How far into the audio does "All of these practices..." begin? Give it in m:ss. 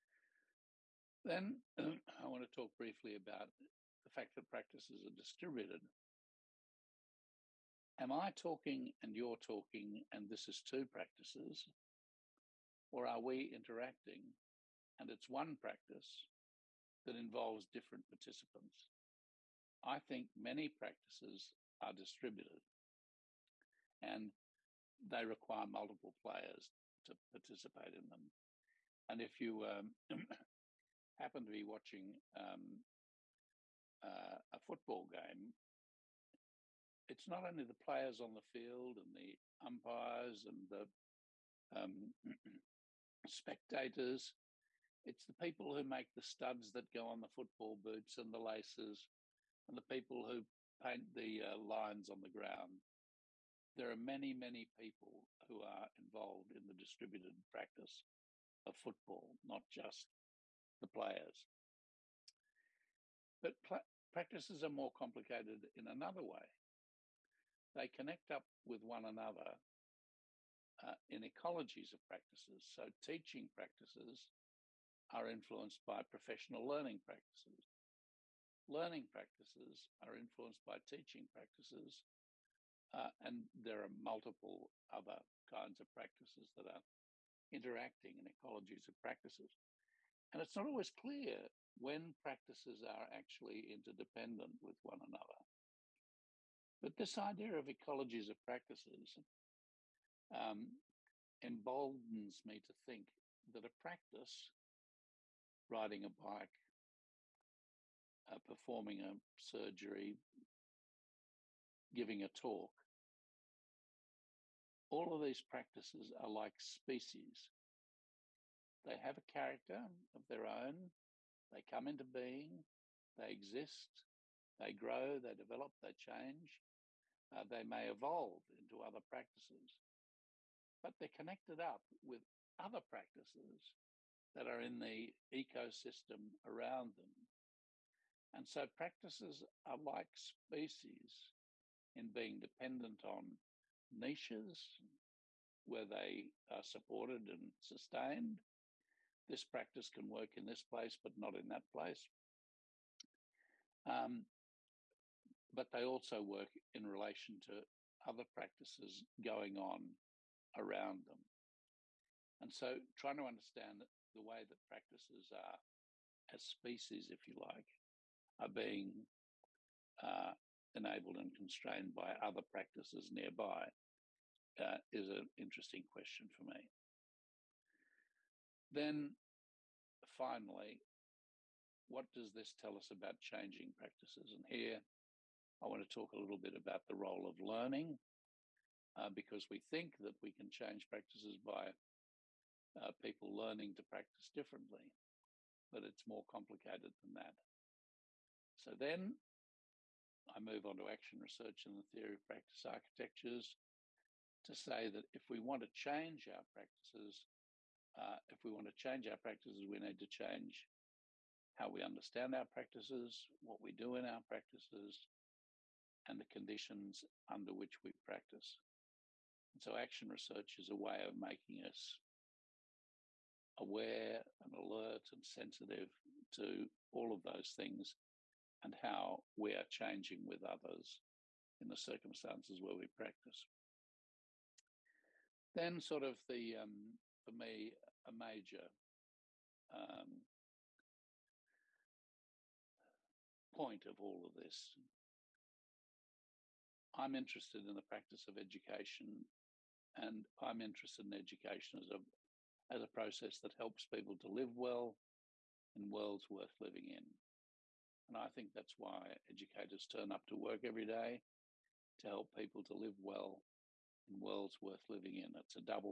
1:54.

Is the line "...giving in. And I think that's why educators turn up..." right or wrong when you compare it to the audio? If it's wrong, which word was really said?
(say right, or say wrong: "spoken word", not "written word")
wrong: "living", not "giving".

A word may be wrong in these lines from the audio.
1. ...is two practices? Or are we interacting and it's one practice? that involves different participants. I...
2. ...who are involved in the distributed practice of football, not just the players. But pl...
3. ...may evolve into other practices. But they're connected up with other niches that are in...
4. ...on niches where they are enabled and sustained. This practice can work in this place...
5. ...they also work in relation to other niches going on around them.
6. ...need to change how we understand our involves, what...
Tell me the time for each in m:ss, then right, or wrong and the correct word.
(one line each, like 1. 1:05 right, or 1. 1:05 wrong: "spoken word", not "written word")
1. 0:10 right
2. 0:55 right
3. 2:07 wrong: "practices", not "niches"
4. 2:23 wrong: "supported", not "enabled"
5. 2:35 wrong: "practices", not "niches"
6. 3:29 wrong: "practices", not "involves".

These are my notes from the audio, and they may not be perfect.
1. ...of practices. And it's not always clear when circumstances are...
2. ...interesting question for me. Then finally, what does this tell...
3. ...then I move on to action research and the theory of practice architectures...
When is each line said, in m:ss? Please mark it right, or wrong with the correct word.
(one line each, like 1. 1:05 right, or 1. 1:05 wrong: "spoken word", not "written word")
1. 1:28 wrong: "practices", not "circumstances"
2. 2:55 right
3. 3:18 right.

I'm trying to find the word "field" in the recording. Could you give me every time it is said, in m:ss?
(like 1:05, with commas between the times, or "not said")
0:38.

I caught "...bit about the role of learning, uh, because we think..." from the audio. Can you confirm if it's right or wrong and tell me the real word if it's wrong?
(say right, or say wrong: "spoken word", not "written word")
right.